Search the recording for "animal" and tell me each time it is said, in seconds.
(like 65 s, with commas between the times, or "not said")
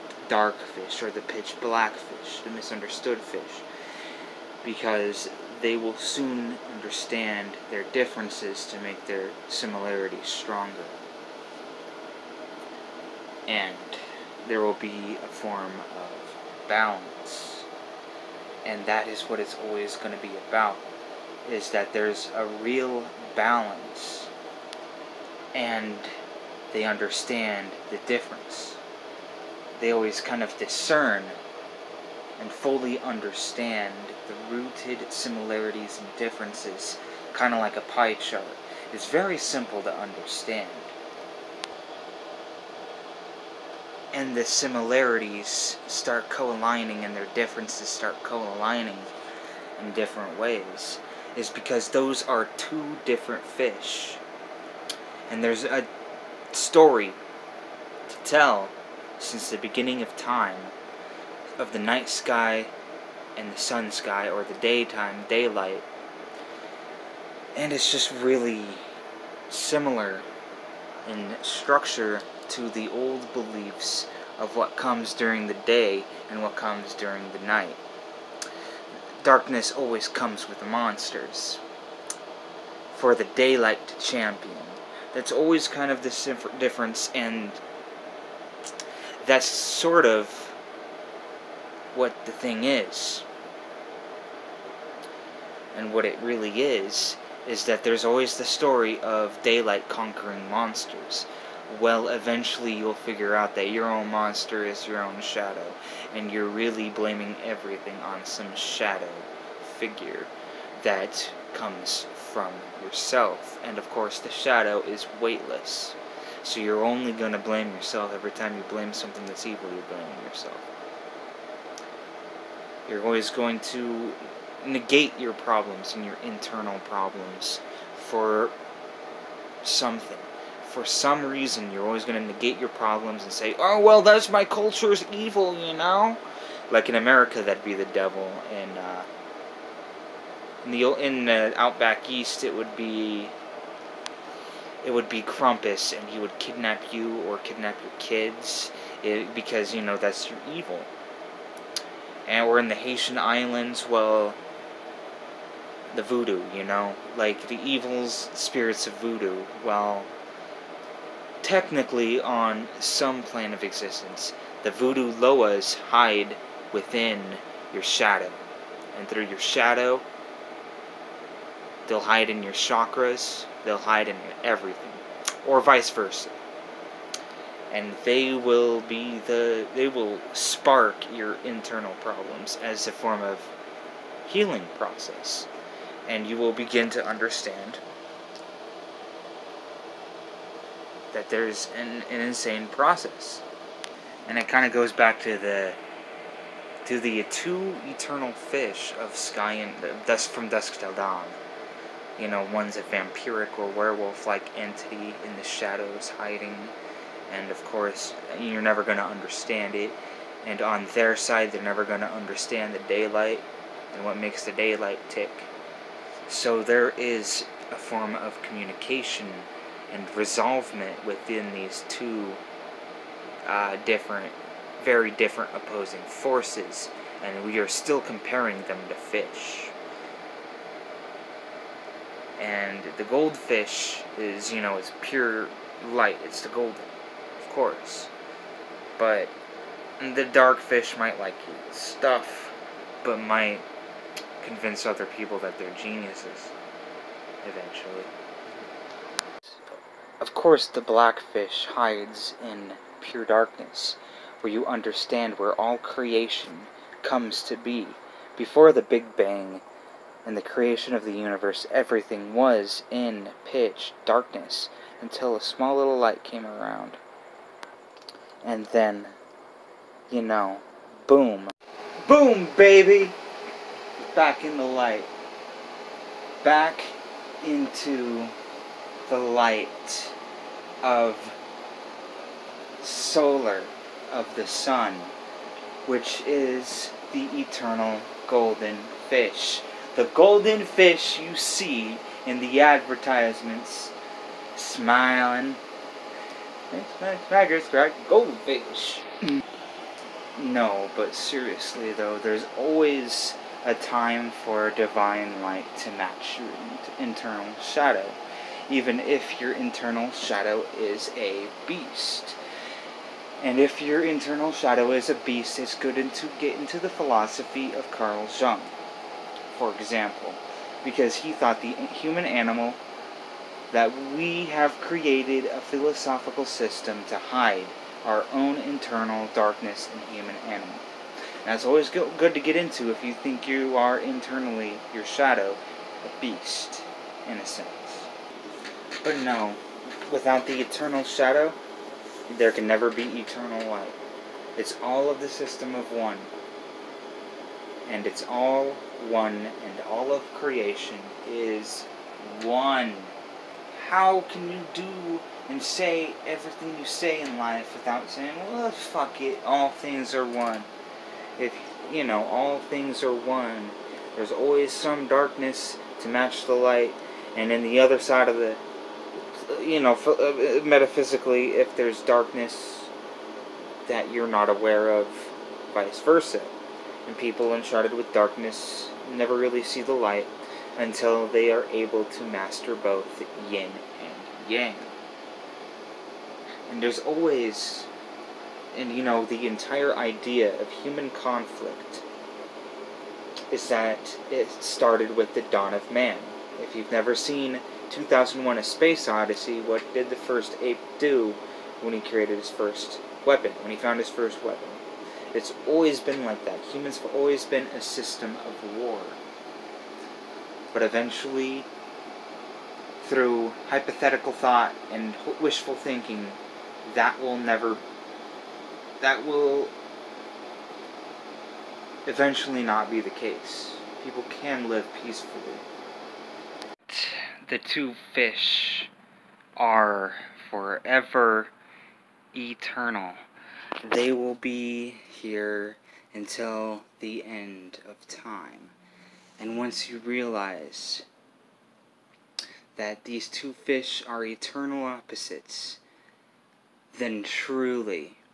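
322 s, 330 s.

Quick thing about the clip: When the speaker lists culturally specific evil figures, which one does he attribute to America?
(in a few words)
The devil.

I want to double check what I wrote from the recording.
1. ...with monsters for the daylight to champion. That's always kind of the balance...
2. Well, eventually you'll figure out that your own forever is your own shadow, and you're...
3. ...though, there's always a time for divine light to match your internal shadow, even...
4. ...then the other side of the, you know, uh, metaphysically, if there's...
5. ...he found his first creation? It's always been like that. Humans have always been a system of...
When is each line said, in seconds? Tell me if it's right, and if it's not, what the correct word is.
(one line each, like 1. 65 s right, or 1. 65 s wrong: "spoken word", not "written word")
1. 80 s wrong: "difference", not "balance"
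2. 101 s wrong: "monster", not "forever"
3. 301 s right
4. 367 s right
5. 403 s wrong: "weapon", not "creation".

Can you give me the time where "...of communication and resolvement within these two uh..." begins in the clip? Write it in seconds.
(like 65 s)
218 s.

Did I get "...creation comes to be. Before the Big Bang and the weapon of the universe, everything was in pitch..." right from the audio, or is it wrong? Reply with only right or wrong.
wrong.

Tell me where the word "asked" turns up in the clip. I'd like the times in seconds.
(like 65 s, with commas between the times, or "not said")
not said.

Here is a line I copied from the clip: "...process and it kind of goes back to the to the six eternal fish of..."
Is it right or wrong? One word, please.
wrong.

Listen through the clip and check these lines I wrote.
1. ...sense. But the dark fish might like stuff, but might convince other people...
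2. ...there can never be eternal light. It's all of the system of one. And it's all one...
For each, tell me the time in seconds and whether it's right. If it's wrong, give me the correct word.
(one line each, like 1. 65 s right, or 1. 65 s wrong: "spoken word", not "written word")
1. 237 s wrong: "course", not "sense"
2. 342 s right.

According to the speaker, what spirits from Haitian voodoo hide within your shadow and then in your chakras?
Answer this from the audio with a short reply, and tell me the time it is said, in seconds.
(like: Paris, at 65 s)
Loas, at 165 s.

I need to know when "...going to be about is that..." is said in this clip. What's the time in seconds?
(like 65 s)
19 s.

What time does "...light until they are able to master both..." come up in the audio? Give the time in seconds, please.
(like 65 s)
379 s.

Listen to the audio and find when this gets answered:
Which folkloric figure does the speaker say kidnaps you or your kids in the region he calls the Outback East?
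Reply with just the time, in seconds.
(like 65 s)
145 s.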